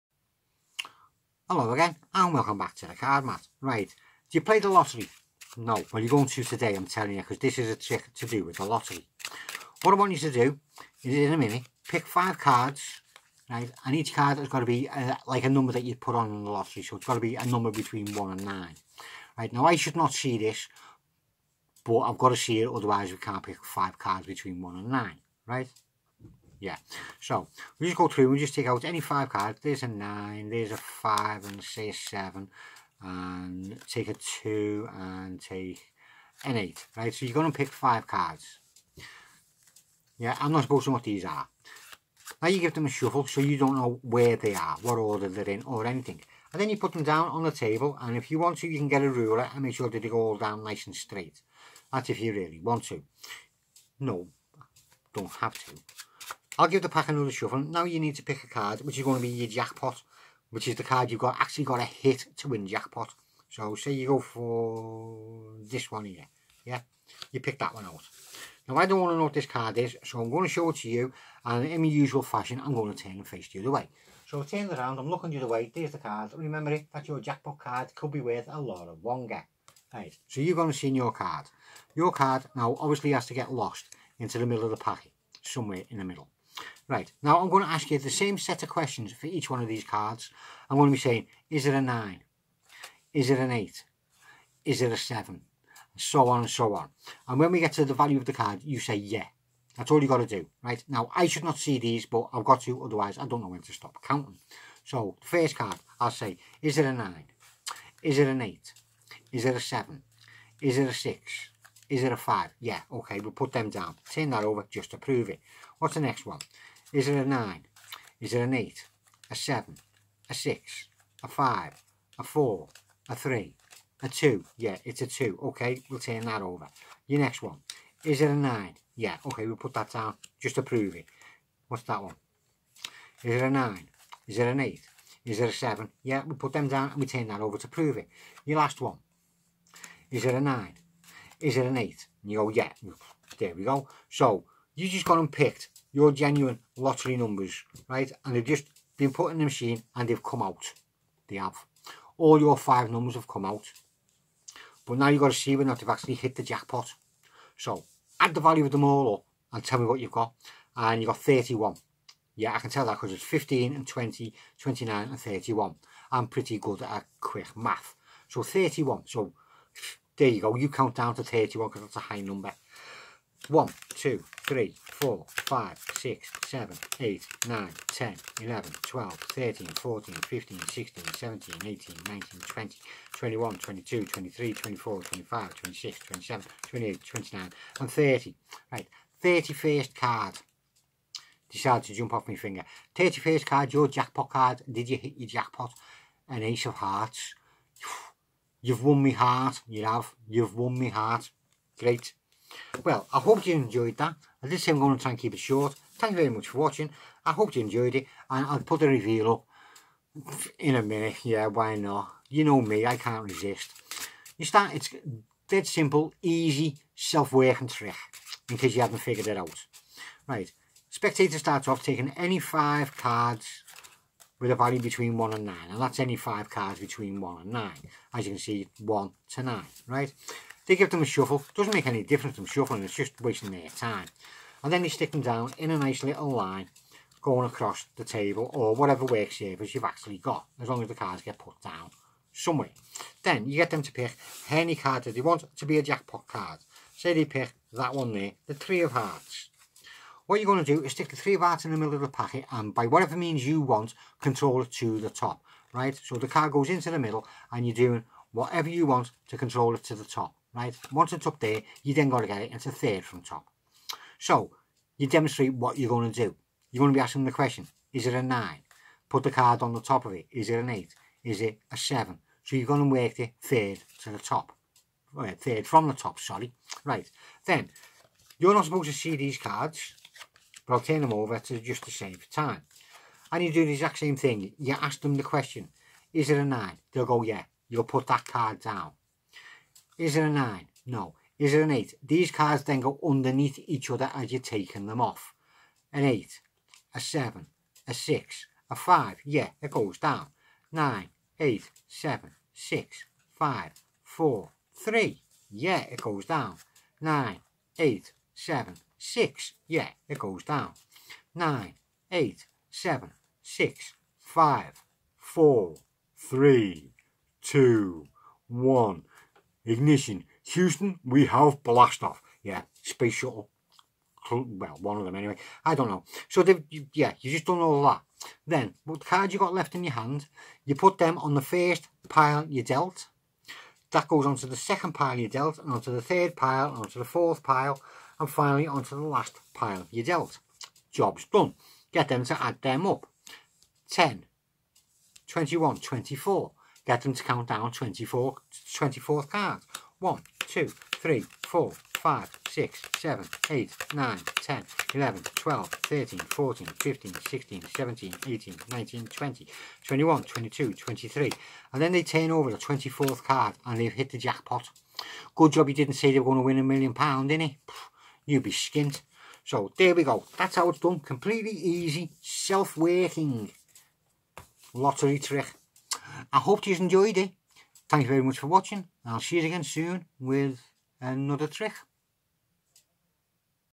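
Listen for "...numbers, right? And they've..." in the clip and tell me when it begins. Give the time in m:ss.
2:27.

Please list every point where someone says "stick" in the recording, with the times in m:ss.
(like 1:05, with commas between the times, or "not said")
3:54, 4:10.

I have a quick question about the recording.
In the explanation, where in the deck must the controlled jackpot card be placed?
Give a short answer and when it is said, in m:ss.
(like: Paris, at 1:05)
third from top, at 4:35.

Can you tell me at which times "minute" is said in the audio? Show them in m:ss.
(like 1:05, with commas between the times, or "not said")
0:11, 3:30.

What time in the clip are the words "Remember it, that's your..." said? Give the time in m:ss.
1:16.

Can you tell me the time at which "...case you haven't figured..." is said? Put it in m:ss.
3:38.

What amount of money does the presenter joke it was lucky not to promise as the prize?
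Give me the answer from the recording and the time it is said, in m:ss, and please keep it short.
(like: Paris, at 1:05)
a million pound, at 6:06.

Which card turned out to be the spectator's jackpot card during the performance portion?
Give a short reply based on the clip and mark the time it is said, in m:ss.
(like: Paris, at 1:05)
Ace of Hearts, at 3:16.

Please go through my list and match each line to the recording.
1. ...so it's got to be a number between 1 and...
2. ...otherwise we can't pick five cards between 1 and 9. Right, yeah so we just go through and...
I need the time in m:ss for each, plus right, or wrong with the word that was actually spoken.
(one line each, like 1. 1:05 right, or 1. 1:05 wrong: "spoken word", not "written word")
1. 0:16 right
2. 0:22 right.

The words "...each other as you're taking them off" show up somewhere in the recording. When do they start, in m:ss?
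4:53.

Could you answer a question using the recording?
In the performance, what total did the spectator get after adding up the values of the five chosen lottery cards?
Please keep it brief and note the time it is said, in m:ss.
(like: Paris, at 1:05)
31, at 2:40.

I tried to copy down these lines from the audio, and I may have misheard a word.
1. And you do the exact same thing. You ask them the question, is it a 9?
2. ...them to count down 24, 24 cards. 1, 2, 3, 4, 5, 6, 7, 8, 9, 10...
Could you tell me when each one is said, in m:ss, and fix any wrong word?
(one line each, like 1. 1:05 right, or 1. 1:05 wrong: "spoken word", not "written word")
1. 4:43 right
2. 5:47 right.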